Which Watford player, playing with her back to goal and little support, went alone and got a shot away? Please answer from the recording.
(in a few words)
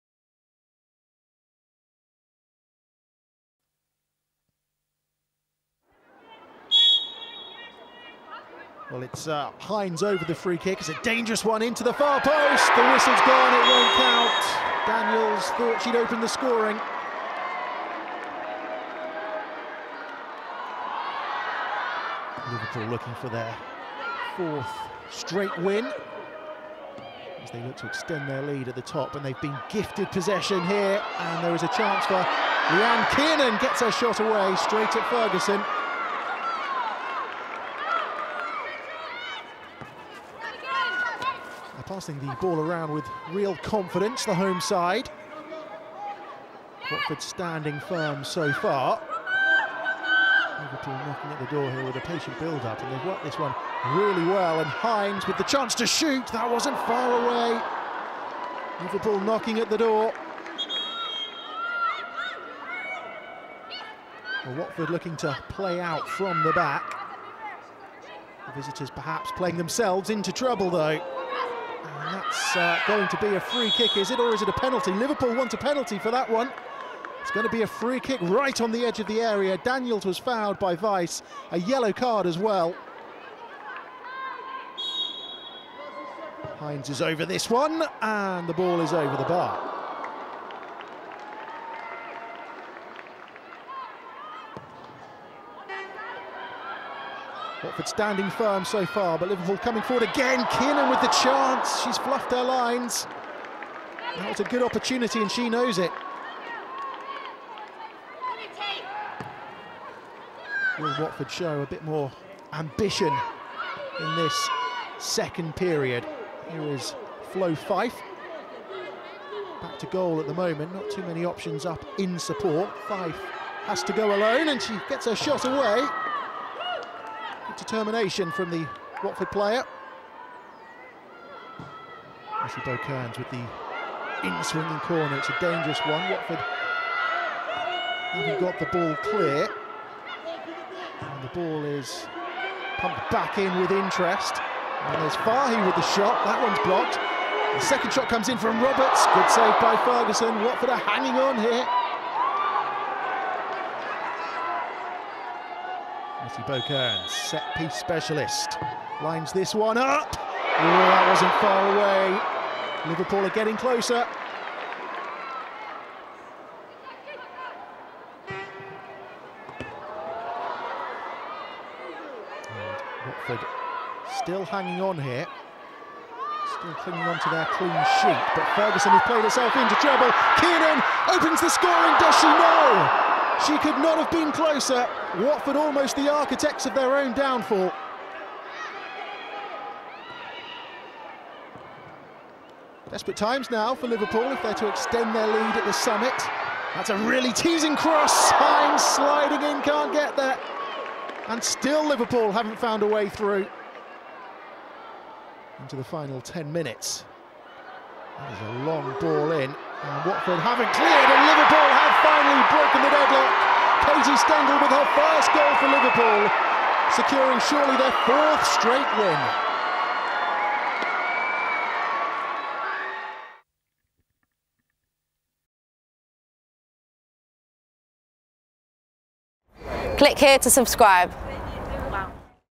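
Flo Fyfe.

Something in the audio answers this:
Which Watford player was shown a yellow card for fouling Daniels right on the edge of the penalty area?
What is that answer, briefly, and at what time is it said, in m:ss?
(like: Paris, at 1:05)
Vice, at 1:20.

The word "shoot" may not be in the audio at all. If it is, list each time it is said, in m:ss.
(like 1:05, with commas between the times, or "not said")
0:55.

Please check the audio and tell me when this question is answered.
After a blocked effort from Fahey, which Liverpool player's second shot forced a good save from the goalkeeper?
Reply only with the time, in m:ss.
2:28.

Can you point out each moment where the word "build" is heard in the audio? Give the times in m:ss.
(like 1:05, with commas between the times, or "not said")
0:52.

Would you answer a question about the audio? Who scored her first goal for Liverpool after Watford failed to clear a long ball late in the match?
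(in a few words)
Susie Stengel.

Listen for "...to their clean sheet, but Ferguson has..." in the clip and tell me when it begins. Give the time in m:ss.
2:57.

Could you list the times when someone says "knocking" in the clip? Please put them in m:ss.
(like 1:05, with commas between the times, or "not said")
0:51, 0:59.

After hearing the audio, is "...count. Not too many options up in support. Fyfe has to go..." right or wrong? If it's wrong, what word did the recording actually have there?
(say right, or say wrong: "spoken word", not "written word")
wrong: "moment", not "count".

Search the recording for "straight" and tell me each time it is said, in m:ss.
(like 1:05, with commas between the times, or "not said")
0:25, 0:34, 3:38.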